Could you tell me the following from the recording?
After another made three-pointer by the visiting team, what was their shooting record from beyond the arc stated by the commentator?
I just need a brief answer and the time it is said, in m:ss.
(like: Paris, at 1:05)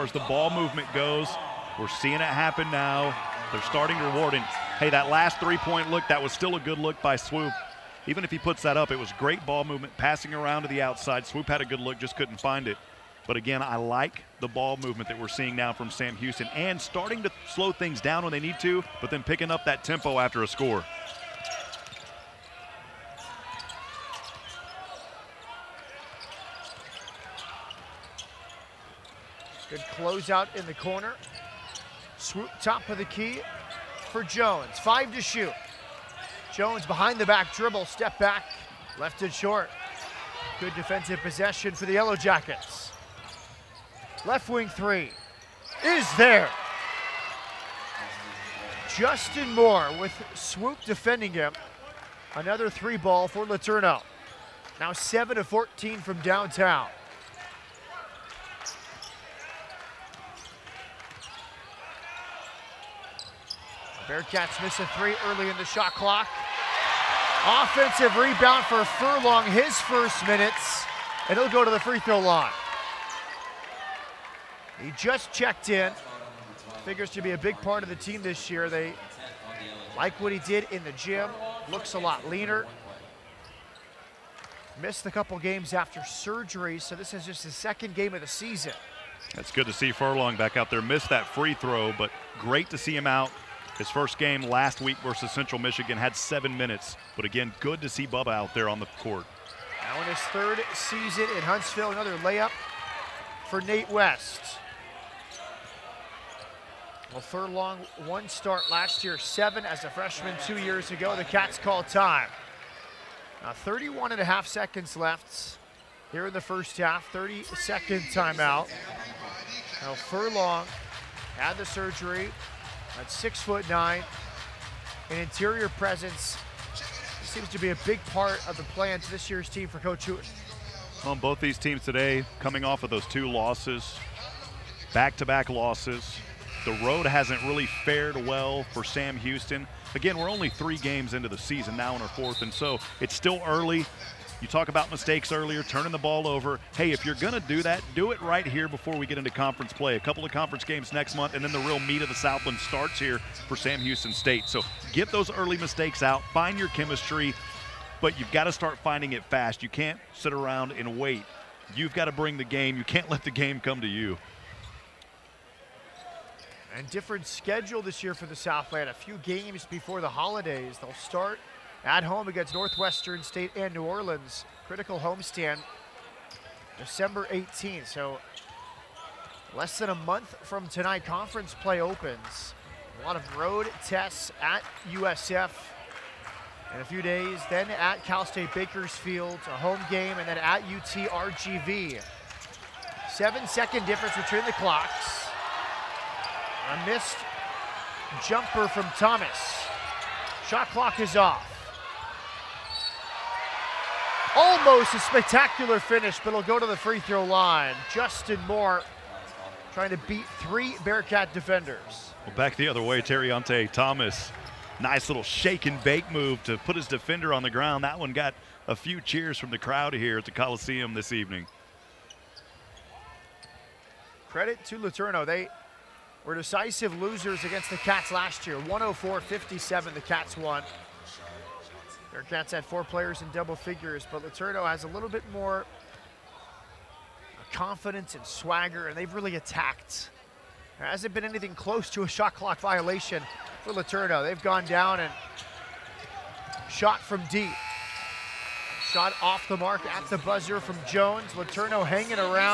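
7 to 14, at 0:54.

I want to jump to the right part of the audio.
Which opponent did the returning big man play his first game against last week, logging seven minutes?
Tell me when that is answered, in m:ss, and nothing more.
1:35.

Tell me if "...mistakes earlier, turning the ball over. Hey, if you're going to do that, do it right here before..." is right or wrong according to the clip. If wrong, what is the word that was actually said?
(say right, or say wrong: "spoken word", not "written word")
right.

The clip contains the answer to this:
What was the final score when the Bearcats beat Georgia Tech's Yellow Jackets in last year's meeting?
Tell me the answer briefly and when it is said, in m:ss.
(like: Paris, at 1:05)
104-57, at 3:48.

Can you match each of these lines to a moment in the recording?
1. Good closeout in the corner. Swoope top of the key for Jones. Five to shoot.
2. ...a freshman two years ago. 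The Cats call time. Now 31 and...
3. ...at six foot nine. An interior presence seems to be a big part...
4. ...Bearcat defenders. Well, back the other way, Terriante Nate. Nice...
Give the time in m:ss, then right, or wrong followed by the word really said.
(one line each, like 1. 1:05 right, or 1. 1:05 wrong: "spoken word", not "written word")
1. 0:29 right
2. 1:49 right
3. 2:03 right
4. 3:30 wrong: "Thomas", not "Nate".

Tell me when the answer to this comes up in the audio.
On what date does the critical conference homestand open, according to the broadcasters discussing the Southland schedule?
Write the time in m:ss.
2:56.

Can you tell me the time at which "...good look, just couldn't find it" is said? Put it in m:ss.
0:11.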